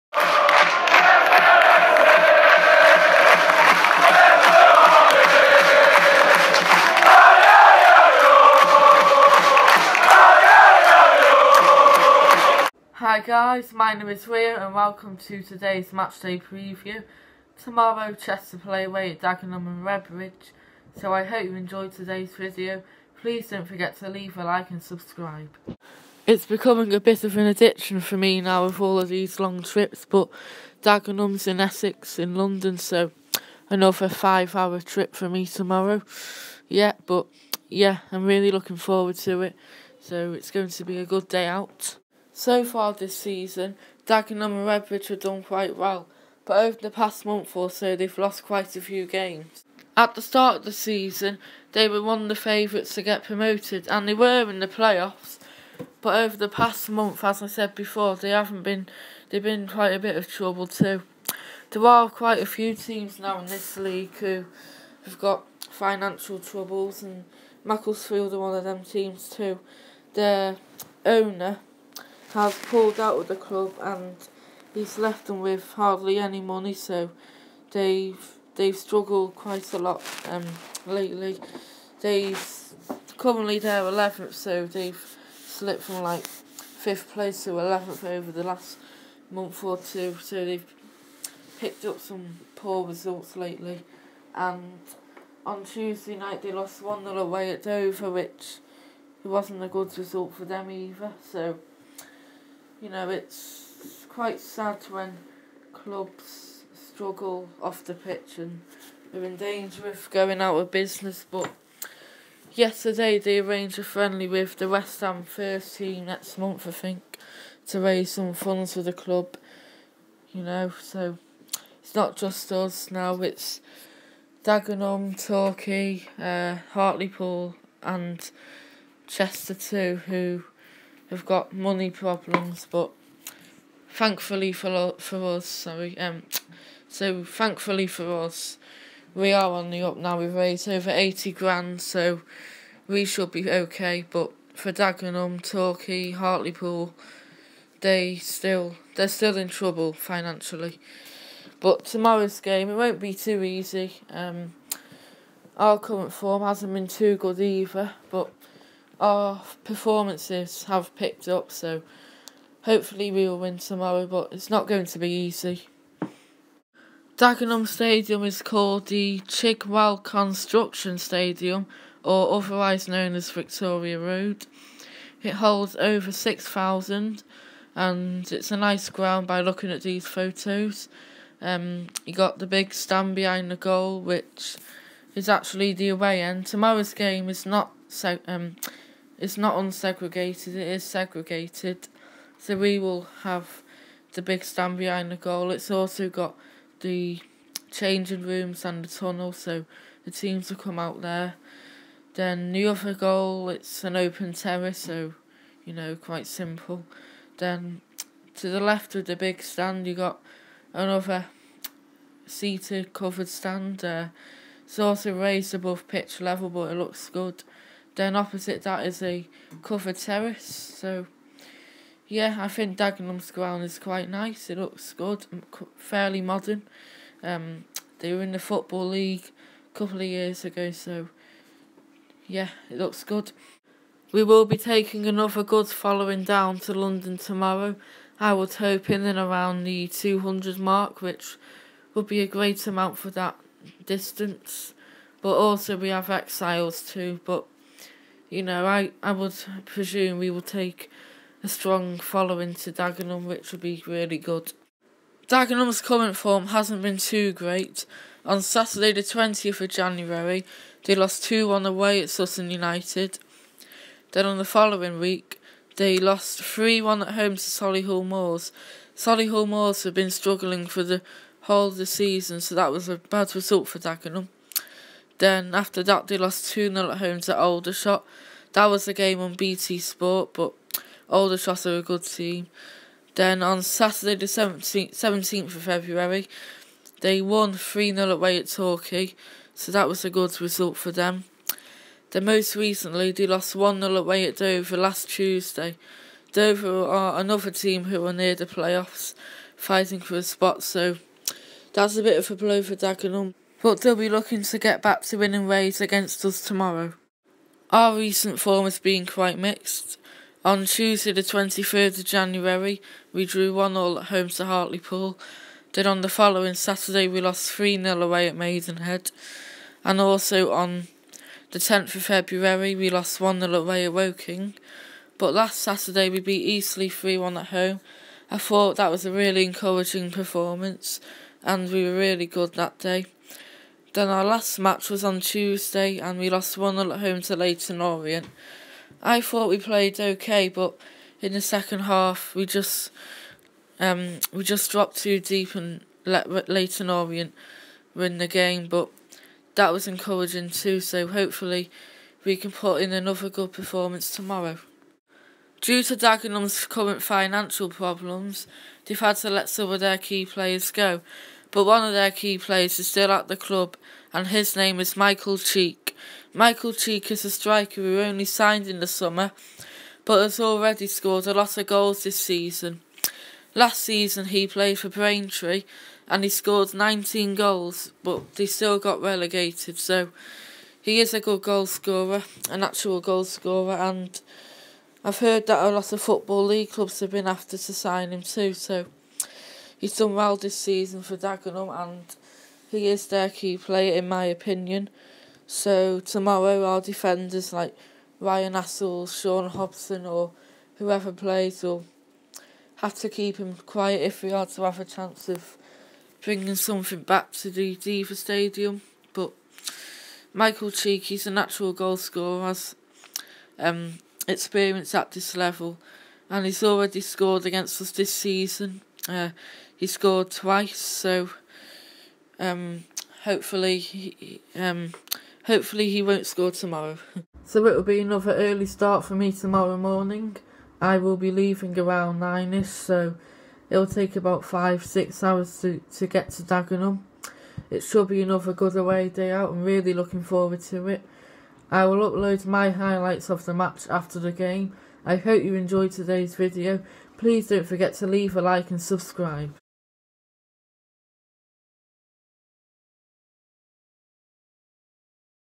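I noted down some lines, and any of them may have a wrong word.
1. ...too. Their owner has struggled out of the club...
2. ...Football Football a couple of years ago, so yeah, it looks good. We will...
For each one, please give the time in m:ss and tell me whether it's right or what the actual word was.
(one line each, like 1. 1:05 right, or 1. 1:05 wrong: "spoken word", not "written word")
1. 1:09 wrong: "pulled", not "struggled"
2. 3:48 wrong: "League", not "Football".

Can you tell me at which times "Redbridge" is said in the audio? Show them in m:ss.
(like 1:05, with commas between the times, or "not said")
0:19, 0:44.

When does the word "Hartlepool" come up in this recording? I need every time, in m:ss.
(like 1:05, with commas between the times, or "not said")
2:06, 2:26, 5:14.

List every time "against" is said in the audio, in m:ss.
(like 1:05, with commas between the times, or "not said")
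5:05, 6:57.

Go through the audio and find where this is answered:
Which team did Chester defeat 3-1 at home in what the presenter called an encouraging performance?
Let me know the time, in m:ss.
5:26.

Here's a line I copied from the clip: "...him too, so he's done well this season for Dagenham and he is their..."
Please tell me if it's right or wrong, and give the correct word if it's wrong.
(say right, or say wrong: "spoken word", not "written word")
right.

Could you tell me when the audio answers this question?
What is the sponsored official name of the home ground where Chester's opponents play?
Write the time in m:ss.
2:49.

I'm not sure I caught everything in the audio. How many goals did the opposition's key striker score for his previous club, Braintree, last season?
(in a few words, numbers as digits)
19.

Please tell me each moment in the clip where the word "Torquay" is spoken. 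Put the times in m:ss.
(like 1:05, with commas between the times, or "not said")
2:05, 2:25, 4:48.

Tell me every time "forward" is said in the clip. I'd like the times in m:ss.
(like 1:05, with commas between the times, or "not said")
0:38, 7:20.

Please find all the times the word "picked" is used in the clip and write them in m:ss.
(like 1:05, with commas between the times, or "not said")
1:31, 2:40.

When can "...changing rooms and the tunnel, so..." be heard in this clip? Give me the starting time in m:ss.
3:17.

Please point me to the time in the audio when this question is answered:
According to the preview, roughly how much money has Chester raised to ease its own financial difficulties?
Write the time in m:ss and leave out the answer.
2:20.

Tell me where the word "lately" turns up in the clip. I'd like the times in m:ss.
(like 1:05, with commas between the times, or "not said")
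1:20, 1:33.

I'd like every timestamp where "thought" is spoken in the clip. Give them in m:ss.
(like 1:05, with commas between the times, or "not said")
5:28, 5:39.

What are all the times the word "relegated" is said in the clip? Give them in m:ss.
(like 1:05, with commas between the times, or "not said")
6:19.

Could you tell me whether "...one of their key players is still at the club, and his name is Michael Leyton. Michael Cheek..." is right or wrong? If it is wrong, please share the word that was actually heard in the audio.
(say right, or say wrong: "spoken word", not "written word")
wrong: "Cheek", not "Leyton".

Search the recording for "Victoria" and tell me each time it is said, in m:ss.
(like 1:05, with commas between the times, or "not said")
2:53.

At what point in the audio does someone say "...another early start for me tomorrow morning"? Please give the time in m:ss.
7:07.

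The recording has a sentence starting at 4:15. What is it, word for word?
Dagenham's current form hasn't been too great.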